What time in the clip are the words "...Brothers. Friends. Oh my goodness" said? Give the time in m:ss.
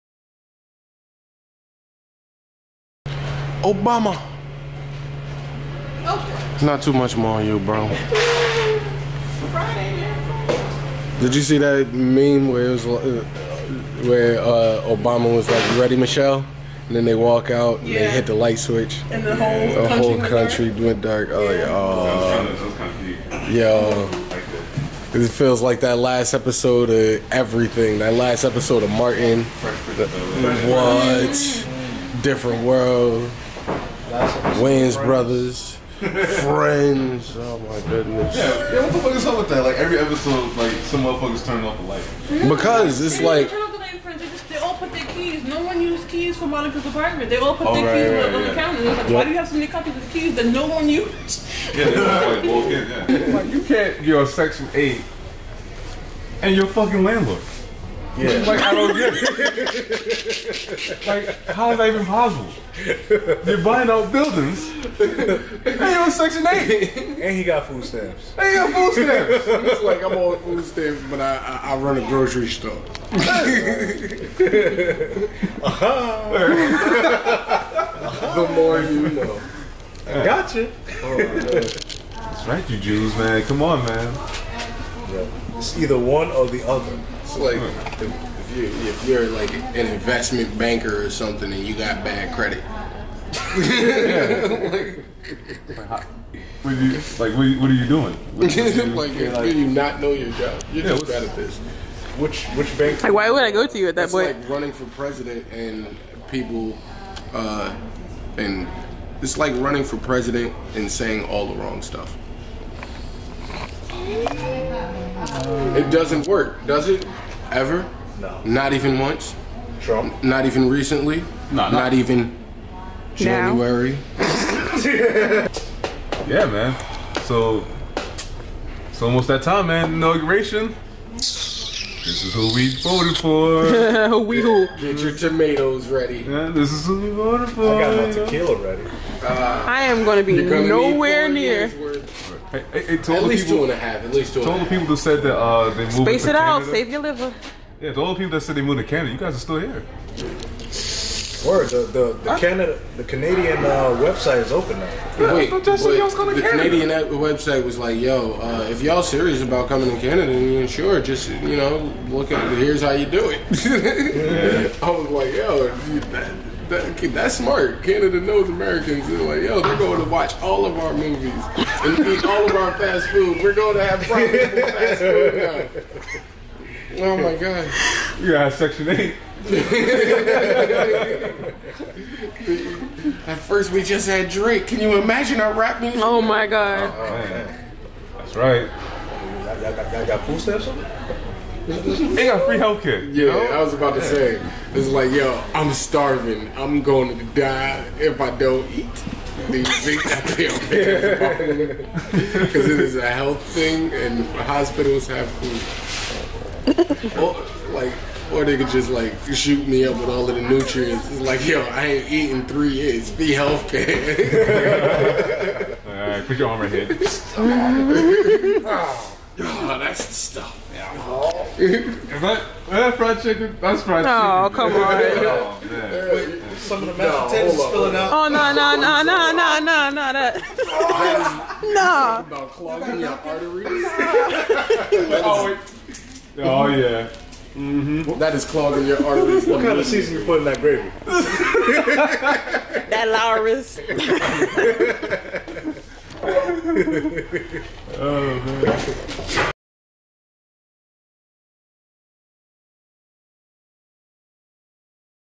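0:35.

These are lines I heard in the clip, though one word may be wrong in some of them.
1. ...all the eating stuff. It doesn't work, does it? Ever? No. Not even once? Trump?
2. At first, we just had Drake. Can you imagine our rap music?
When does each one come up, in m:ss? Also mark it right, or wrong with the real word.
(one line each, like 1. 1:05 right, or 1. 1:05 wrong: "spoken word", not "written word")
1. 1:51 wrong: "wrong", not "eating"
2. 3:03 right.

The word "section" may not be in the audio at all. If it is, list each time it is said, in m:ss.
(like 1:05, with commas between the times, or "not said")
0:54, 1:06, 2:58.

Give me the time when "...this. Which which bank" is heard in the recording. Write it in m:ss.
1:41.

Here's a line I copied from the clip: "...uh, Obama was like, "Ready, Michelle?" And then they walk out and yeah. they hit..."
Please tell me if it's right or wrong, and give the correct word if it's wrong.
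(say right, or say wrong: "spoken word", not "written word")
right.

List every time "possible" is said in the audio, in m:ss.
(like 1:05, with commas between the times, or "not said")
1:02.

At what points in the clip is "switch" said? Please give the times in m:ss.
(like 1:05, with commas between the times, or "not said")
0:18.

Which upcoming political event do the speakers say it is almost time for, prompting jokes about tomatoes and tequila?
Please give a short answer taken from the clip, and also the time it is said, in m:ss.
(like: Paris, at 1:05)
Inauguration, at 2:09.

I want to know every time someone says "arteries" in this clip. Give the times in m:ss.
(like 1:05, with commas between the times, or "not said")
3:53, 3:59.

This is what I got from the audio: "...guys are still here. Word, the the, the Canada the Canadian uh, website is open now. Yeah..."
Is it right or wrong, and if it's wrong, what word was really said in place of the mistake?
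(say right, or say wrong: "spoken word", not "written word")
right.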